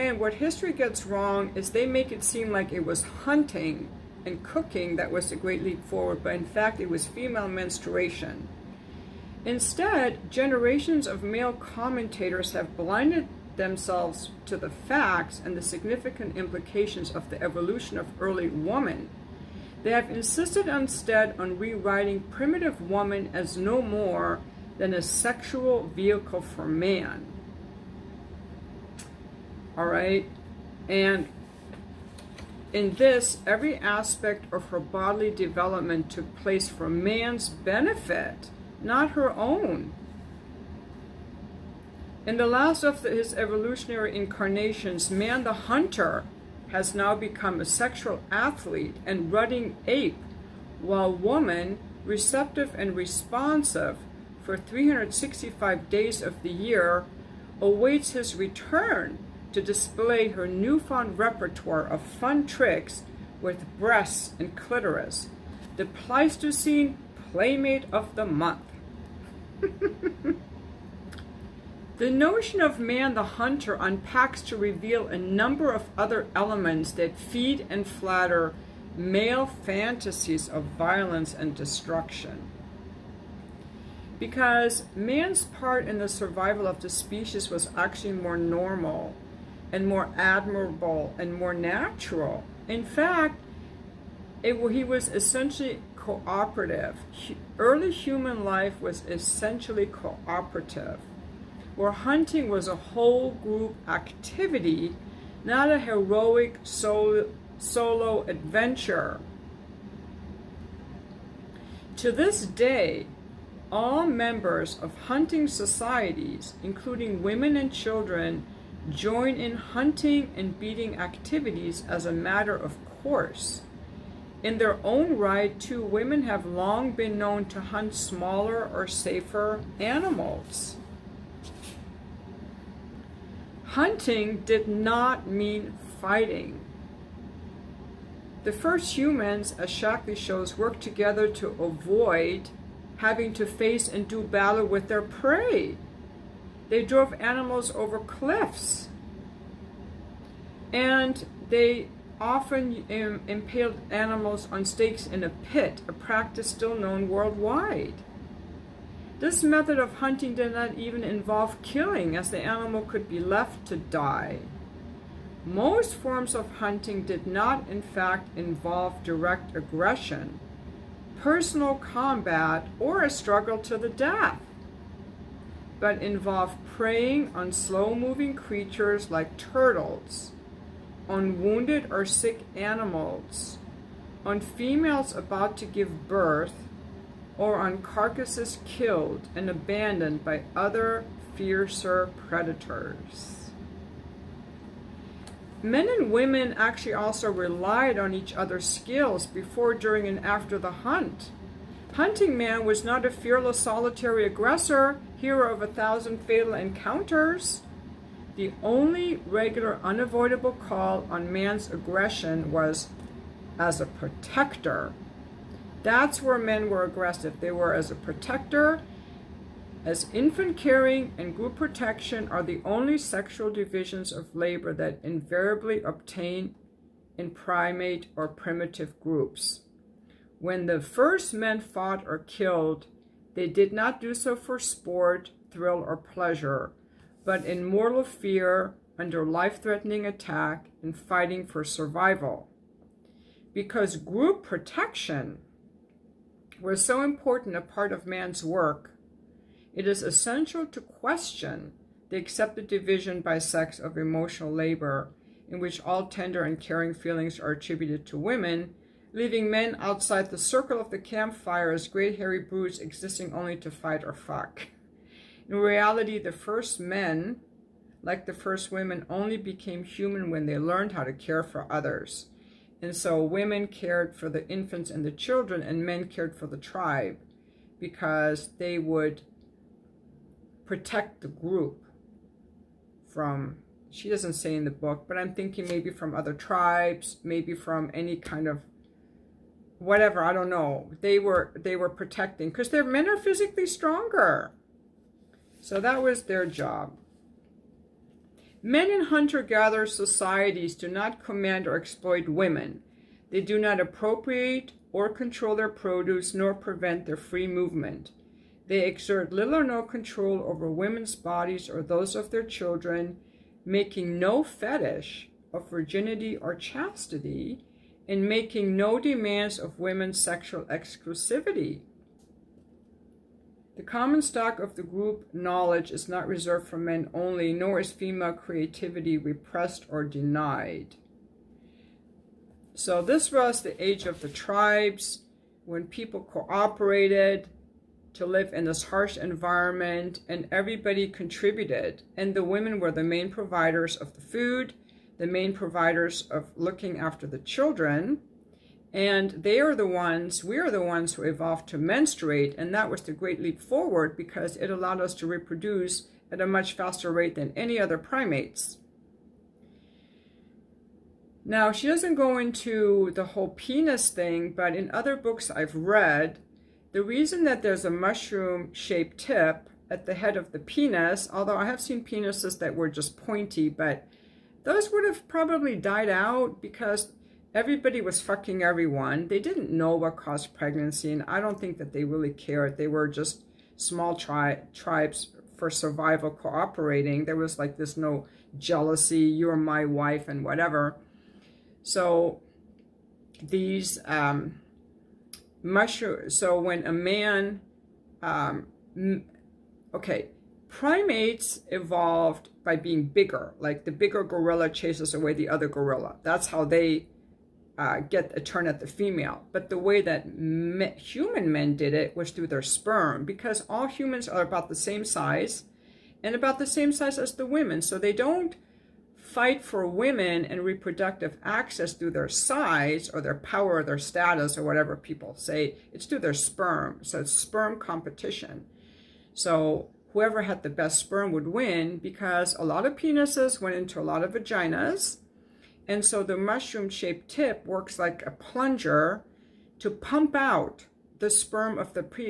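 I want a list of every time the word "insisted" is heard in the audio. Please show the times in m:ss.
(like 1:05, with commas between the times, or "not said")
0:20.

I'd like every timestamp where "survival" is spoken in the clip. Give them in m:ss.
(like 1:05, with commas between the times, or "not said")
1:26, 4:01, 6:25.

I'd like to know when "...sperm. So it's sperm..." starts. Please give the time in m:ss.
7:06.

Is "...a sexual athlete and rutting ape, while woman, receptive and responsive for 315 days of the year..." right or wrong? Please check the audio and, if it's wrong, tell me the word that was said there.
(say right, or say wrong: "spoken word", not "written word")
wrong: "365", not "315".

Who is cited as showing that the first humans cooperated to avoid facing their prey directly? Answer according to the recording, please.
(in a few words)
Shakti.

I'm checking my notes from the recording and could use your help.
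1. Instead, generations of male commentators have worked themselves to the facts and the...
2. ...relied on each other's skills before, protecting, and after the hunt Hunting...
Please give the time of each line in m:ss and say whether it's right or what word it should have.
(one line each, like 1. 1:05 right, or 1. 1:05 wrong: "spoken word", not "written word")
1. 0:09 wrong: "blinded", not "worked"
2. 3:17 wrong: "during", not "protecting".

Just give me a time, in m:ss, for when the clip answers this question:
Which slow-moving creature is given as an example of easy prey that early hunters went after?
2:59.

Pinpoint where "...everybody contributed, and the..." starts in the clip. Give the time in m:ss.
5:40.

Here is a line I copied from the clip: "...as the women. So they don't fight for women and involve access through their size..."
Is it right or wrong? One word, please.
wrong.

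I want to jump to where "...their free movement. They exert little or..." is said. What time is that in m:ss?
5:07.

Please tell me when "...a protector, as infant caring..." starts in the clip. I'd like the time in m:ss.
3:37.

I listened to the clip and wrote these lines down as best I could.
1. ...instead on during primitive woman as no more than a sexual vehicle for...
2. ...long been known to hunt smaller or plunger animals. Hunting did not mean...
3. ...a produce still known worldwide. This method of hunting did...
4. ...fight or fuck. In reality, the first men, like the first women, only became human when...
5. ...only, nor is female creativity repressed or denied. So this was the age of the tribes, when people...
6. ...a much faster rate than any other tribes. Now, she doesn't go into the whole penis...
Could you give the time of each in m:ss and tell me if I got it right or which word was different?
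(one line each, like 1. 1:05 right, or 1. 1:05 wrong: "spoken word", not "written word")
1. 0:20 wrong: "rewriting", not "during"
2. 2:06 wrong: "safer", not "plunger"
3. 2:35 wrong: "practice", not "produce"
4. 4:23 right
5. 5:27 right
6. 5:56 wrong: "primates", not "tribes".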